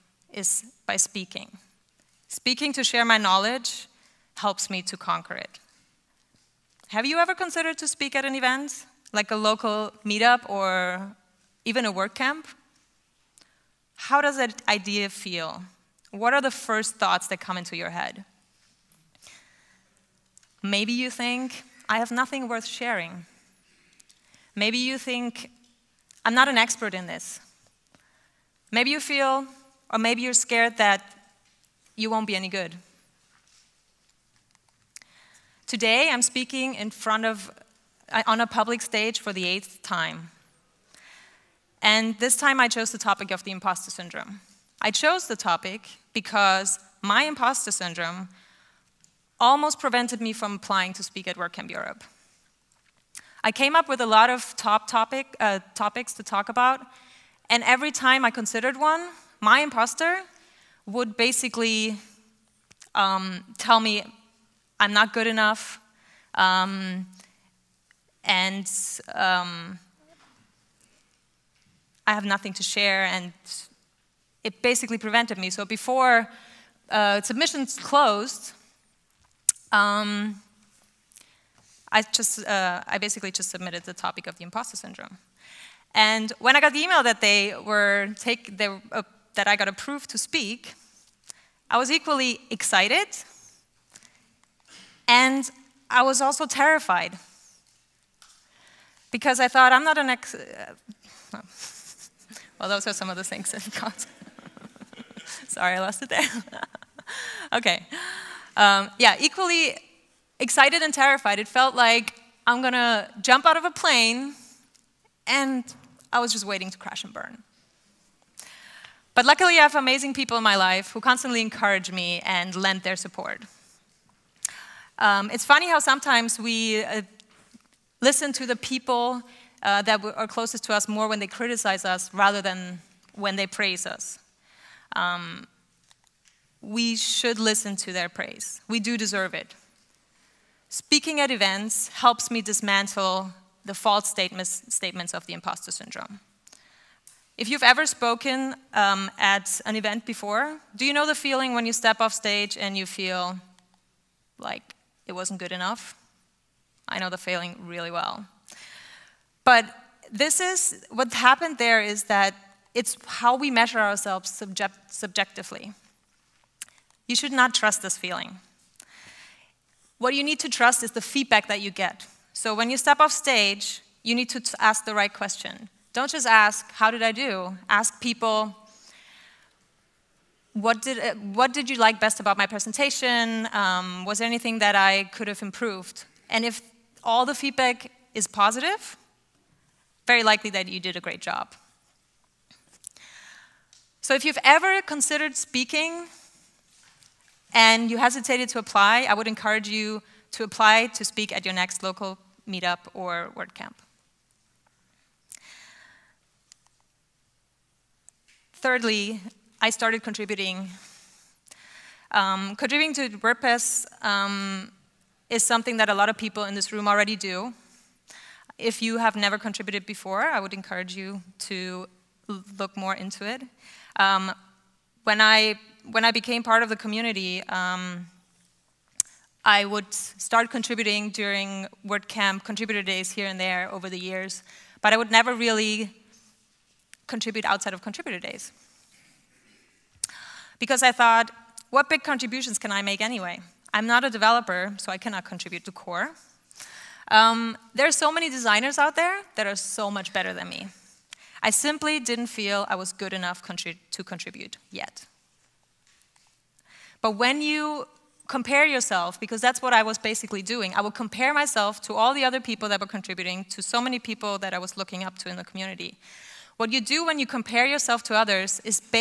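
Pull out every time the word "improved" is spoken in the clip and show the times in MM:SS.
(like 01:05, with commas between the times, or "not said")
03:05.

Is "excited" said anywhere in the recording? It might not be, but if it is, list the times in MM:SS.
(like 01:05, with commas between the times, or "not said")
01:32, 01:50.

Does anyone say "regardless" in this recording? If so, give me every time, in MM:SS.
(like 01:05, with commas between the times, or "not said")
not said.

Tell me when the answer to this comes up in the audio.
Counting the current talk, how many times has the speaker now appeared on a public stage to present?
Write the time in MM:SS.
00:39.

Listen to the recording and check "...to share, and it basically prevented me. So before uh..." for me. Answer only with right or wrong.
right.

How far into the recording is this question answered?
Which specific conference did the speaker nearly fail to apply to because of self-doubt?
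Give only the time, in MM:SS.
00:51.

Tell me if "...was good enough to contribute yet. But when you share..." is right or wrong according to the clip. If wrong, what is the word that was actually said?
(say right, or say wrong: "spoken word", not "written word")
wrong: "compare", not "share".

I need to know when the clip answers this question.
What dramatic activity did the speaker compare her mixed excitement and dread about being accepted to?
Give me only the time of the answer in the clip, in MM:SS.
01:53.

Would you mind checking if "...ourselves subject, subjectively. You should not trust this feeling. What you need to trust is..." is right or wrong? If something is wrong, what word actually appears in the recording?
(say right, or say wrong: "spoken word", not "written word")
right.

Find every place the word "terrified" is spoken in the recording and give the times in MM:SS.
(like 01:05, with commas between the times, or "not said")
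01:36, 01:50.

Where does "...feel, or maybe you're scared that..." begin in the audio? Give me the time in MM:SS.
00:28.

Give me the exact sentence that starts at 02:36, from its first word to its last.
I know the failing really well.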